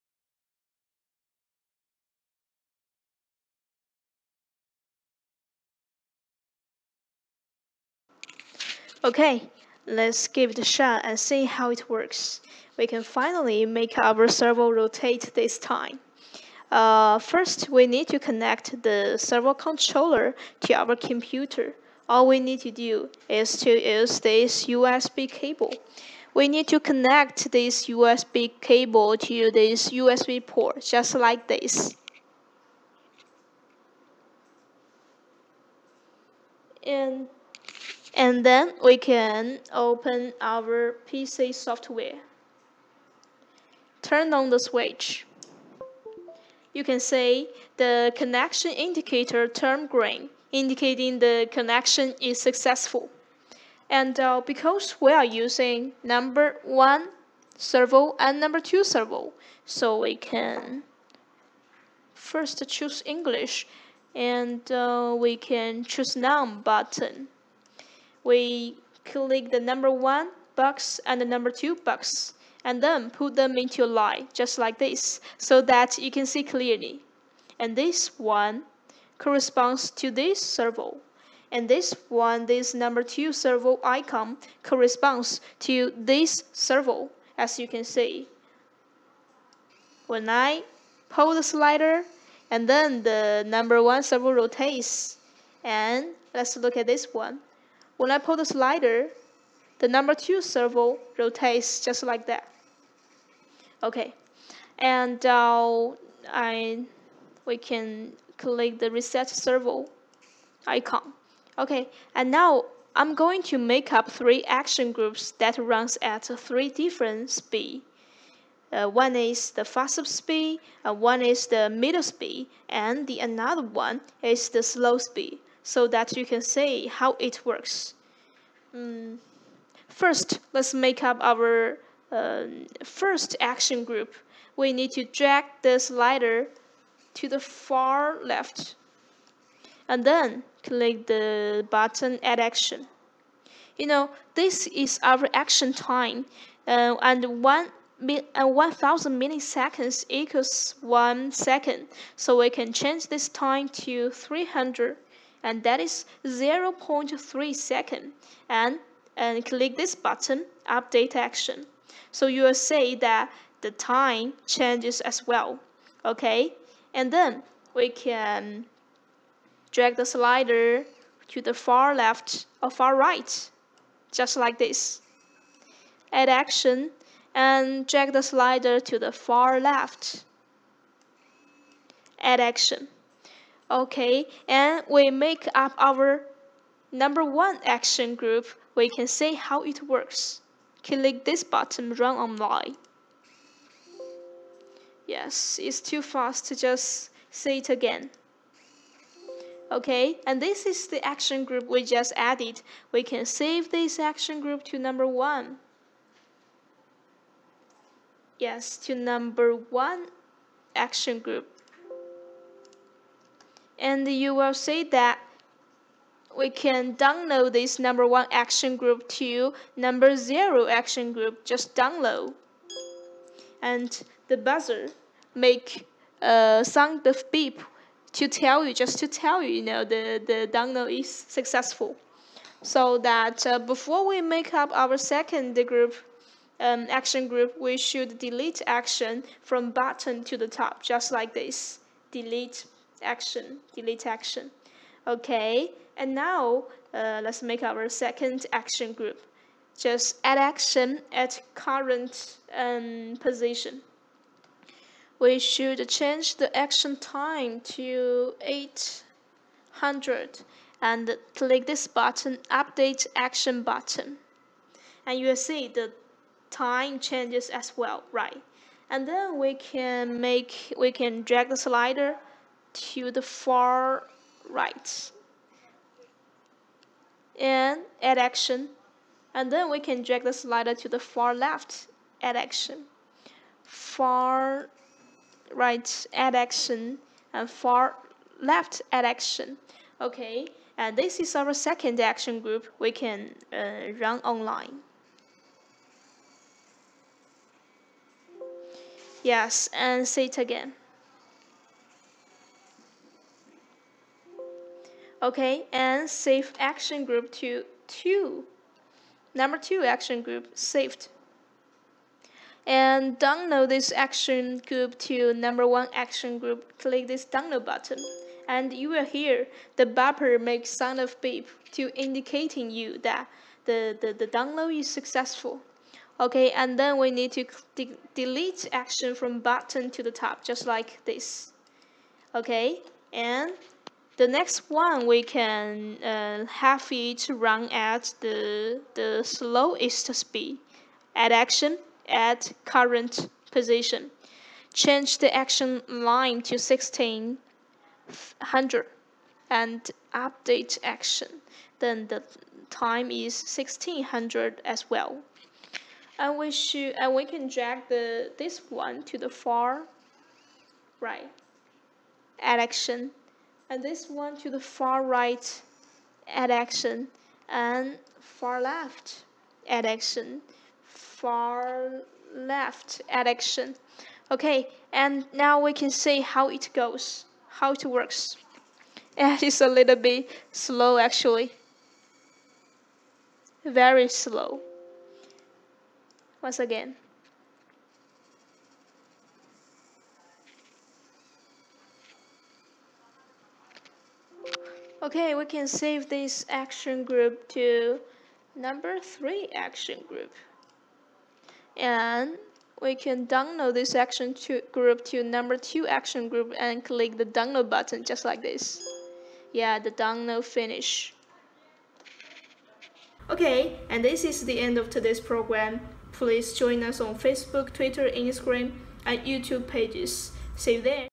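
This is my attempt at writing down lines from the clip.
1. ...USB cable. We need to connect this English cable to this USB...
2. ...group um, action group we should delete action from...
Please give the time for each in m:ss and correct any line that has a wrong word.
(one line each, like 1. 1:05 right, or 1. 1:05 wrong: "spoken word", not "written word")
1. 0:24 wrong: "USB", not "English"
2. 3:55 right.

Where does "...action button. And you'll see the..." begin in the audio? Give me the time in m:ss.
4:23.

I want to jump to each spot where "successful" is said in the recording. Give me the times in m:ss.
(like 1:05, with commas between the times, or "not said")
0:52, 3:51, 5:24.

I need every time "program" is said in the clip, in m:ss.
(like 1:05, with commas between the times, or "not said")
6:55.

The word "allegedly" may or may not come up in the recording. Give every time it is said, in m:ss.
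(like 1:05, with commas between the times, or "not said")
not said.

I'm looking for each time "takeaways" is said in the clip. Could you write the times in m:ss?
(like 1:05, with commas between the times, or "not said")
not said.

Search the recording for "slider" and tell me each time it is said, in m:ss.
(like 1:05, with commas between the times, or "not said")
1:31, 1:38, 2:15, 2:50, 2:58, 4:31, 4:40.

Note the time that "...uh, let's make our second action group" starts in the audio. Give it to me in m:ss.
4:06.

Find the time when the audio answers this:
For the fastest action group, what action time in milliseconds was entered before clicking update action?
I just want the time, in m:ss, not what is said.
2:34.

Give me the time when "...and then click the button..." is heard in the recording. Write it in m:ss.
2:19.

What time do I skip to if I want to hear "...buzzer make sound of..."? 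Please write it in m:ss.
5:19.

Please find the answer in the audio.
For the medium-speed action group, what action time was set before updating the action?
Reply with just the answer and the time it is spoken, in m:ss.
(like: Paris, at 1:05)
800, at 4:18.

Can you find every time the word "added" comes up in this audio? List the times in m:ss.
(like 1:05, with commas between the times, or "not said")
3:22.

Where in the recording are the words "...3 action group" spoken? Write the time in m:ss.
6:38.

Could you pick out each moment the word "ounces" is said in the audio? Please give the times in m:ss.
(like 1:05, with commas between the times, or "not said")
not said.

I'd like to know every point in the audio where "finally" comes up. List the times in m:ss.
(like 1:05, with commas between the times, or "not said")
0:13.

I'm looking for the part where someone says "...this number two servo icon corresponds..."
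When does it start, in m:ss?
1:22.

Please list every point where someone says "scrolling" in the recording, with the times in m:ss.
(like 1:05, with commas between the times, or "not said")
not said.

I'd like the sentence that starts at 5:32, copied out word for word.
Okay, and the next one we can uh, have it run at the, the slowest speed at action at current position.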